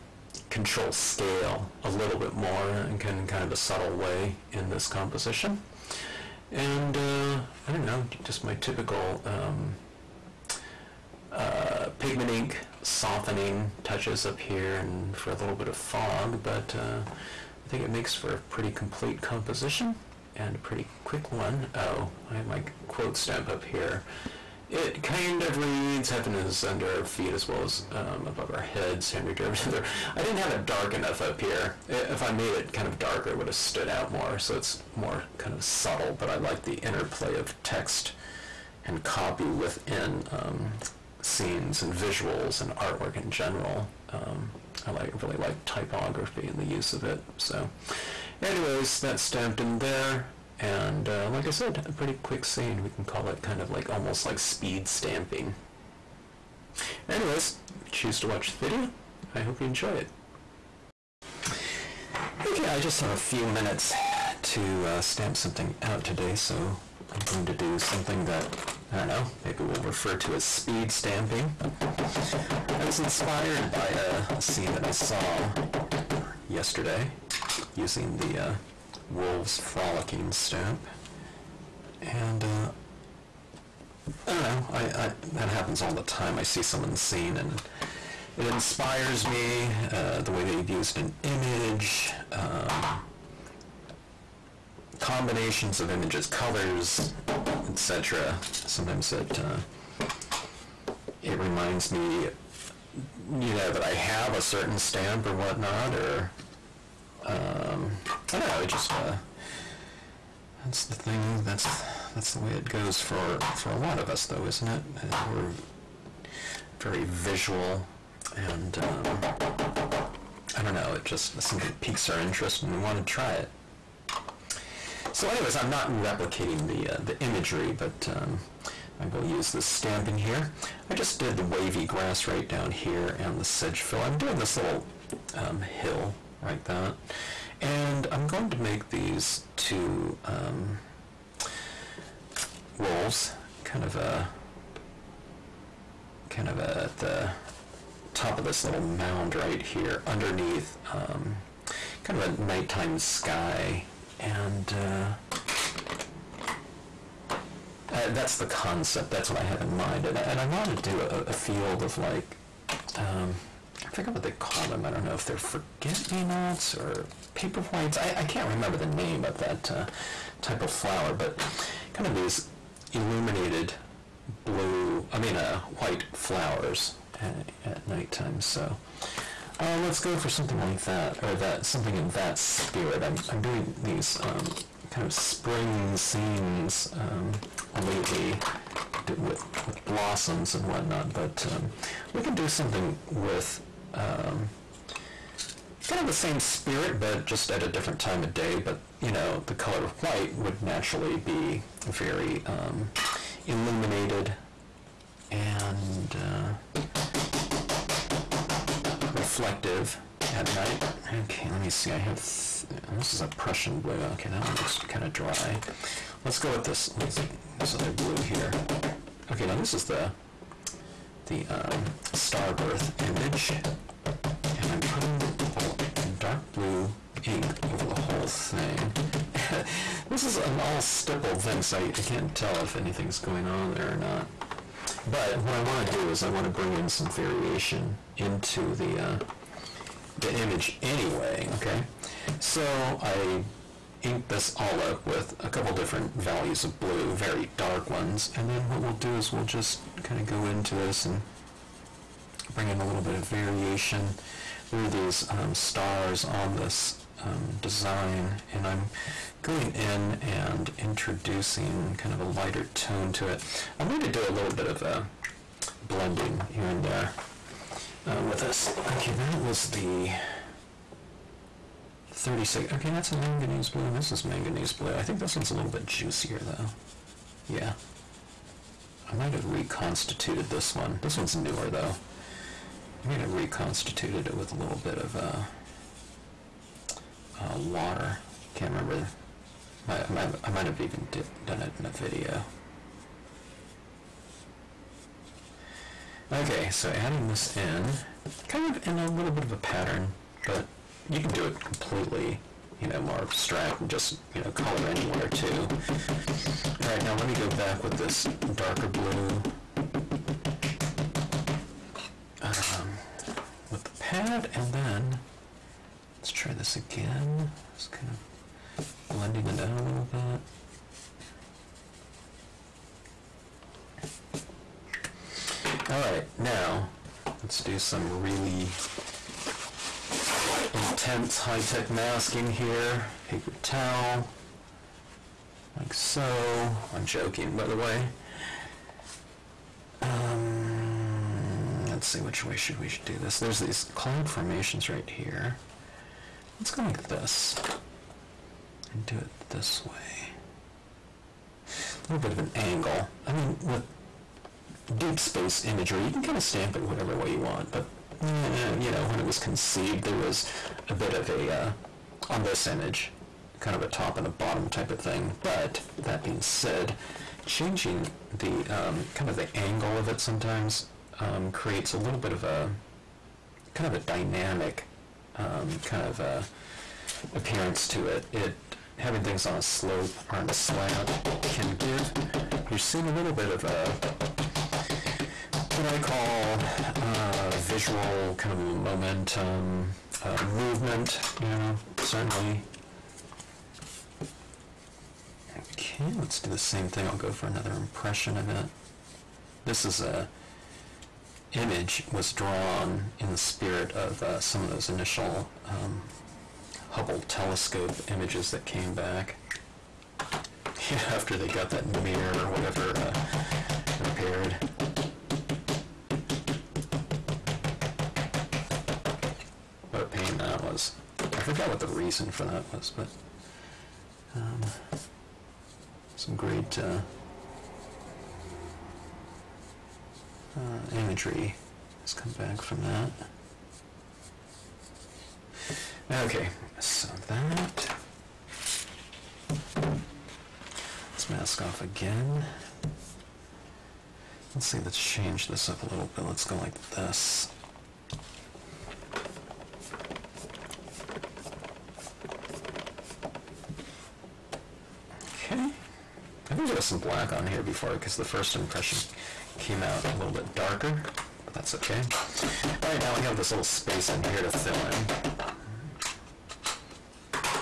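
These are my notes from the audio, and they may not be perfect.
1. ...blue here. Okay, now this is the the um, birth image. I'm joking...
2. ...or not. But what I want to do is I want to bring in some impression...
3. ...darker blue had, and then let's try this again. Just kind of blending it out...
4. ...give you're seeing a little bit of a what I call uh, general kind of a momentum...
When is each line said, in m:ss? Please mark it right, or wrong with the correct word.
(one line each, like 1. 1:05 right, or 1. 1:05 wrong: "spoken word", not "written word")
1. 3:37 wrong: "putting", not "joking"
2. 3:53 wrong: "variation", not "impression"
3. 5:08 right
4. 6:21 wrong: "visual", not "general".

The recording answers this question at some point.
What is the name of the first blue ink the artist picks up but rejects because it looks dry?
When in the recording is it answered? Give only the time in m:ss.
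3:33.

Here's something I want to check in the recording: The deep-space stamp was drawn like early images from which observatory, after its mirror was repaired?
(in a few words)
Hubble telescope.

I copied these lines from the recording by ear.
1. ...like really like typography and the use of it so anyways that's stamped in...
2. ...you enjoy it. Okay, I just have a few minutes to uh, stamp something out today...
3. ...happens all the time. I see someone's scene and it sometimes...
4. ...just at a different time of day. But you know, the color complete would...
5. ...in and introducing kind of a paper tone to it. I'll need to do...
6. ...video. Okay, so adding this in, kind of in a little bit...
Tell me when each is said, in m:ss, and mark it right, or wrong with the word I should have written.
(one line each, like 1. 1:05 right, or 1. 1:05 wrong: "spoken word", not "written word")
1. 0:44 right
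2. 0:59 right
3. 1:25 wrong: "inspires", not "sometimes"
4. 3:17 wrong: "white", not "complete"
5. 4:19 wrong: "lighter", not "paper"
6. 4:51 right.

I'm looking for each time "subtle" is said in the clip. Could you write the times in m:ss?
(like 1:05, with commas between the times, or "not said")
0:03, 0:35.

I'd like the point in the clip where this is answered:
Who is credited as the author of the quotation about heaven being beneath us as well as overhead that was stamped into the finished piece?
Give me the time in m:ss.
0:29.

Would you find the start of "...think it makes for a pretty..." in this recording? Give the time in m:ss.
0:17.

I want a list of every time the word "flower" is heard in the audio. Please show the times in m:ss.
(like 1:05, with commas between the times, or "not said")
2:50, 2:56.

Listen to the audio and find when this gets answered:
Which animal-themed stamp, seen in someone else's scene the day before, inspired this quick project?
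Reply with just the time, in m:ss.
1:19.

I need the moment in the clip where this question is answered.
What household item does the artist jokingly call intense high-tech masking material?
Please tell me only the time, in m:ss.
5:33.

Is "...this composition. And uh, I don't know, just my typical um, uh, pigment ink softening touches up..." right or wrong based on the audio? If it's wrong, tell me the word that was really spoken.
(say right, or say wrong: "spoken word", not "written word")
right.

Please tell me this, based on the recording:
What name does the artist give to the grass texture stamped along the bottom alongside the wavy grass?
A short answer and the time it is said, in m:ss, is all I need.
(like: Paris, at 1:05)
sedge fill, at 2:13.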